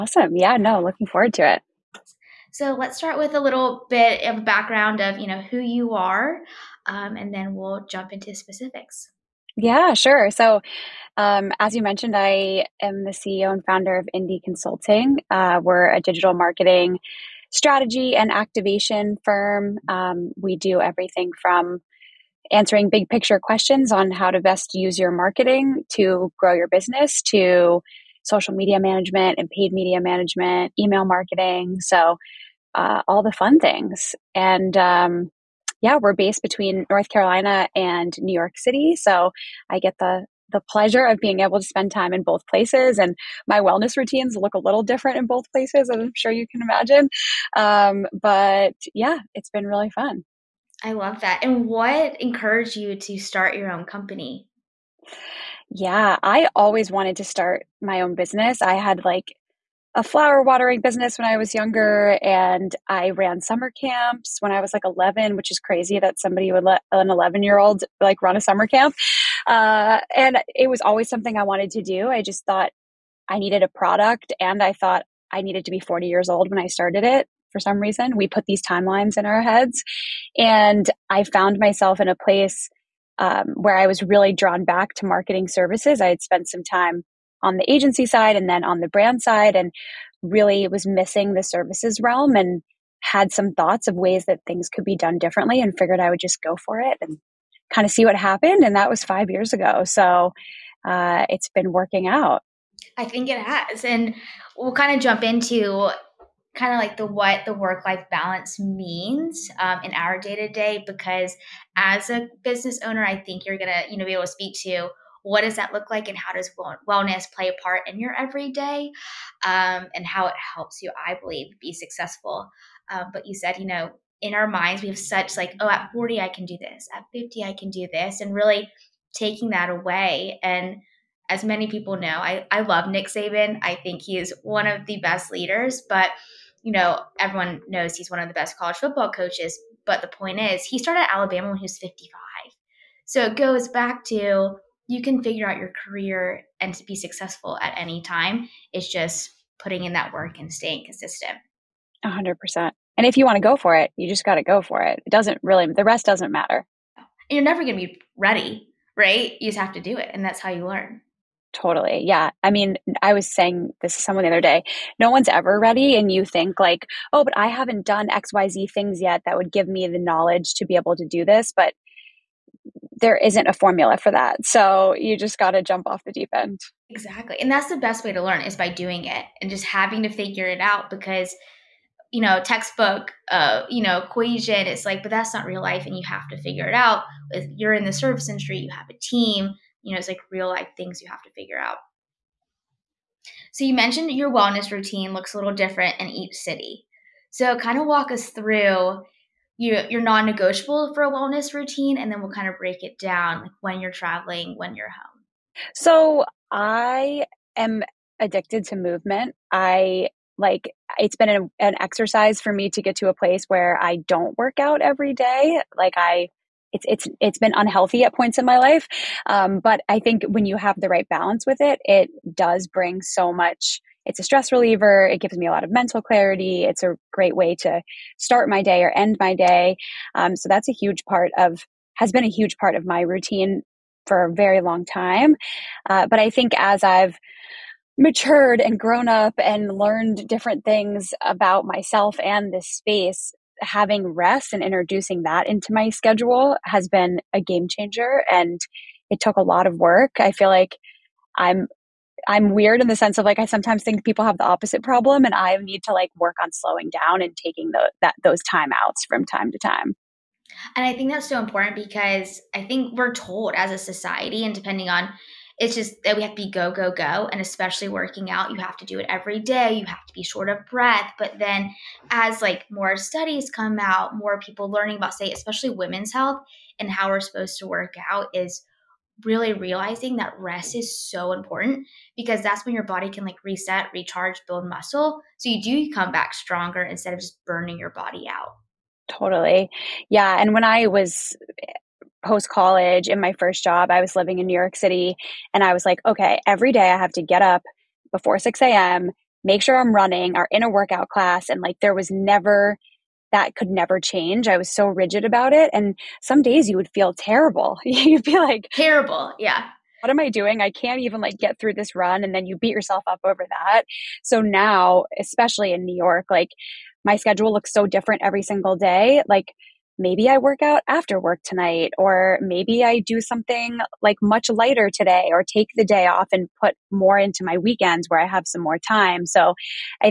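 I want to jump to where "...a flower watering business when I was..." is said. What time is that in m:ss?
0:59.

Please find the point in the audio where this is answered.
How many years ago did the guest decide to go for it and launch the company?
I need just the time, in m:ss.
1:39.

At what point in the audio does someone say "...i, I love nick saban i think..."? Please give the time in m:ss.
2:12.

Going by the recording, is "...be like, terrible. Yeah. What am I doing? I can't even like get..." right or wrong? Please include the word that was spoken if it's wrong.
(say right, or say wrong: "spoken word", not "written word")
right.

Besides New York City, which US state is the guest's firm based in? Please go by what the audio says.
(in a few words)
North Carolina.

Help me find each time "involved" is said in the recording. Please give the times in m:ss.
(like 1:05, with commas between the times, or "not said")
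not said.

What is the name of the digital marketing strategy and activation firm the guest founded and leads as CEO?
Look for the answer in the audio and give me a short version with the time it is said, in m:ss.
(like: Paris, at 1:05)
Indie Consulting, at 0:14.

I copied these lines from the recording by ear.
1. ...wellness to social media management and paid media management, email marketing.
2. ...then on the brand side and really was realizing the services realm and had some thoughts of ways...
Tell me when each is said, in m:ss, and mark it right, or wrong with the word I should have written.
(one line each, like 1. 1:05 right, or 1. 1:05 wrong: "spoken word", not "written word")
1. 0:26 wrong: "business", not "wellness"
2. 1:28 wrong: "missing", not "realizing".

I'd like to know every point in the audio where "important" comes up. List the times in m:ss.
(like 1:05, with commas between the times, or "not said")
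4:21, 4:41.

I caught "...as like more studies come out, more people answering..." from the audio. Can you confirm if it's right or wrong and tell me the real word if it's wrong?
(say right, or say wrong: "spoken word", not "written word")
wrong: "learning", not "answering".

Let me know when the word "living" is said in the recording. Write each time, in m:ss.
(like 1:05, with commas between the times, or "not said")
4:54.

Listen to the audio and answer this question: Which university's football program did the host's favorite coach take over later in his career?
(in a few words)
Alabama.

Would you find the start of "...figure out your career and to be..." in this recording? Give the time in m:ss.
2:25.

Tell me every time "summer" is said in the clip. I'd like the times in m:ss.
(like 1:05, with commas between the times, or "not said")
1:03, 1:08.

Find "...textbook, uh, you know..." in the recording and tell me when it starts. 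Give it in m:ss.
3:02.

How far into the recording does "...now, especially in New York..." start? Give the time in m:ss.
5:14.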